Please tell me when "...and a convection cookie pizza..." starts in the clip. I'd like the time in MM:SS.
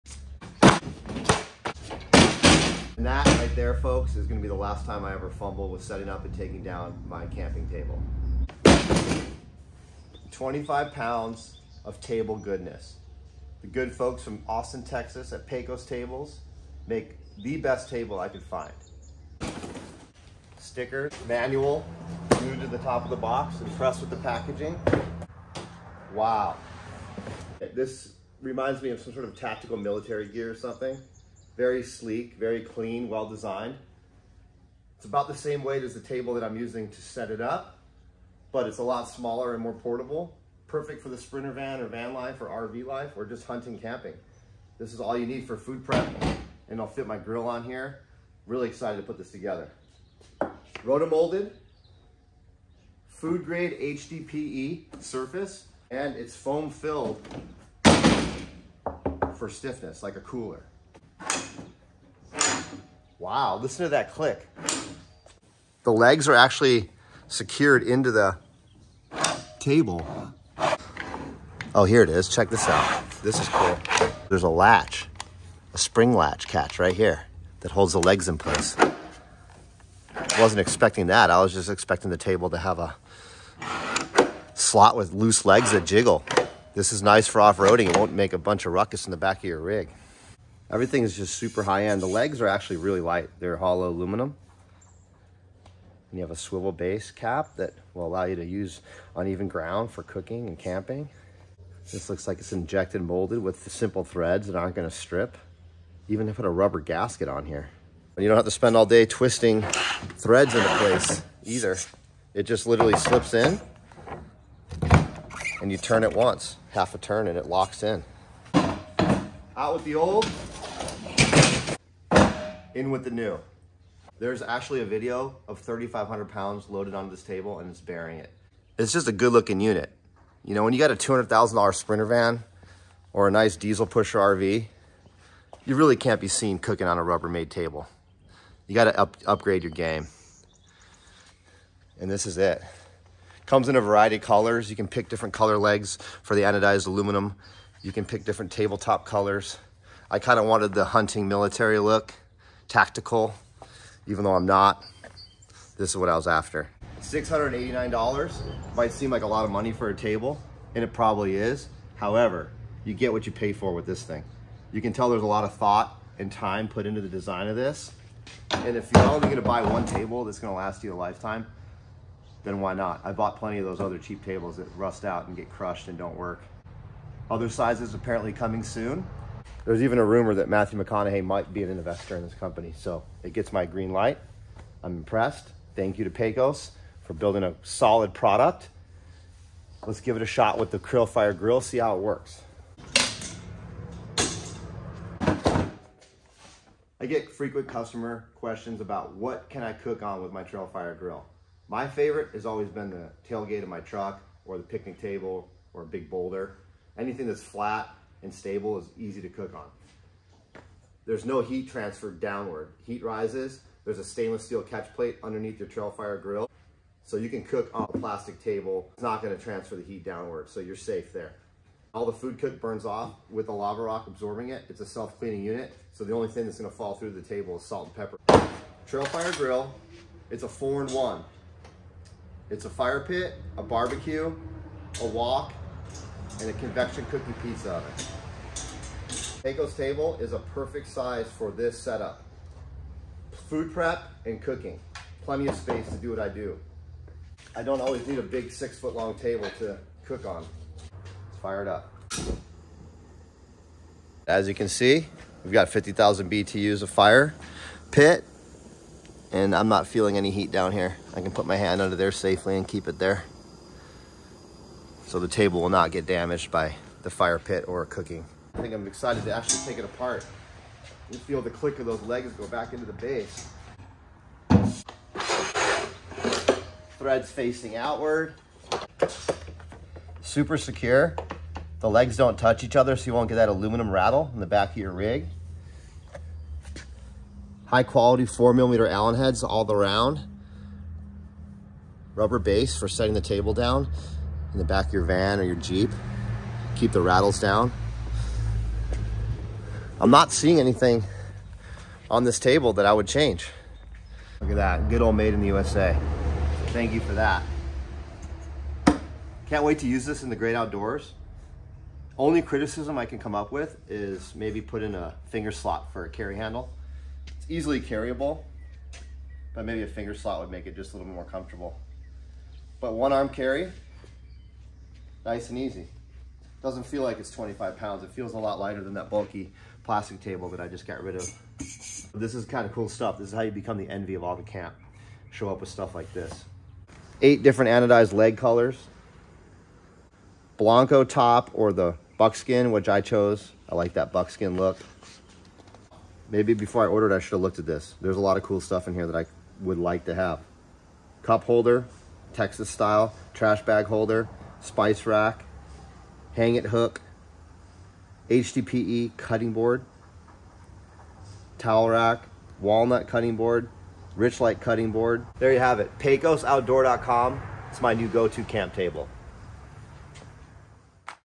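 03:56.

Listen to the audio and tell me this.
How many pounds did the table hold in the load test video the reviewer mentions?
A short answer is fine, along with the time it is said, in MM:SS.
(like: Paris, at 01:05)
3,500 pounds, at 02:05.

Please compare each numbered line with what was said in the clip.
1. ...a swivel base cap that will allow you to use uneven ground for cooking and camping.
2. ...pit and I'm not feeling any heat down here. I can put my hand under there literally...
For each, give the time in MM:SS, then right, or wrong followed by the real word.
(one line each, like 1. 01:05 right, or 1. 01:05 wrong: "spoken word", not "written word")
1. 01:36 right
2. 04:17 wrong: "safely", not "literally".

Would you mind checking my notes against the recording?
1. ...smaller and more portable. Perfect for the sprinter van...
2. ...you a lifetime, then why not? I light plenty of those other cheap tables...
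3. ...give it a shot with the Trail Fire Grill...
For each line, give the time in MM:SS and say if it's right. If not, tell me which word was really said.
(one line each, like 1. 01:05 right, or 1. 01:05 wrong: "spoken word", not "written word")
1. 00:39 right
2. 02:50 wrong: "bought", not "light"
3. 03:10 right.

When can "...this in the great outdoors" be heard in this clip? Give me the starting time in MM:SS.
05:10.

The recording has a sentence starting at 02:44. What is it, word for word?
You can tell there's a lot of thought and time put into the design of this.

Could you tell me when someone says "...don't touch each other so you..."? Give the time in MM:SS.
04:42.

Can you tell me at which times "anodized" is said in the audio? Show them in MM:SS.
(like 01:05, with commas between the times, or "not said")
02:26, 05:37.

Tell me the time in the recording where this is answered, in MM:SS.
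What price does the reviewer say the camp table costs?
02:37.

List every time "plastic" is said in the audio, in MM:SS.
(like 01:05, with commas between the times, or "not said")
03:37, 05:29.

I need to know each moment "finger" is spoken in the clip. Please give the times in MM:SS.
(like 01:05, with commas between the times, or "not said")
05:15, 05:19.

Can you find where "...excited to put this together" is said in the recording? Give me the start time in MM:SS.
00:48.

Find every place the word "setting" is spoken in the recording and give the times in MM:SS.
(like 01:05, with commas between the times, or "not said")
00:05, 04:52.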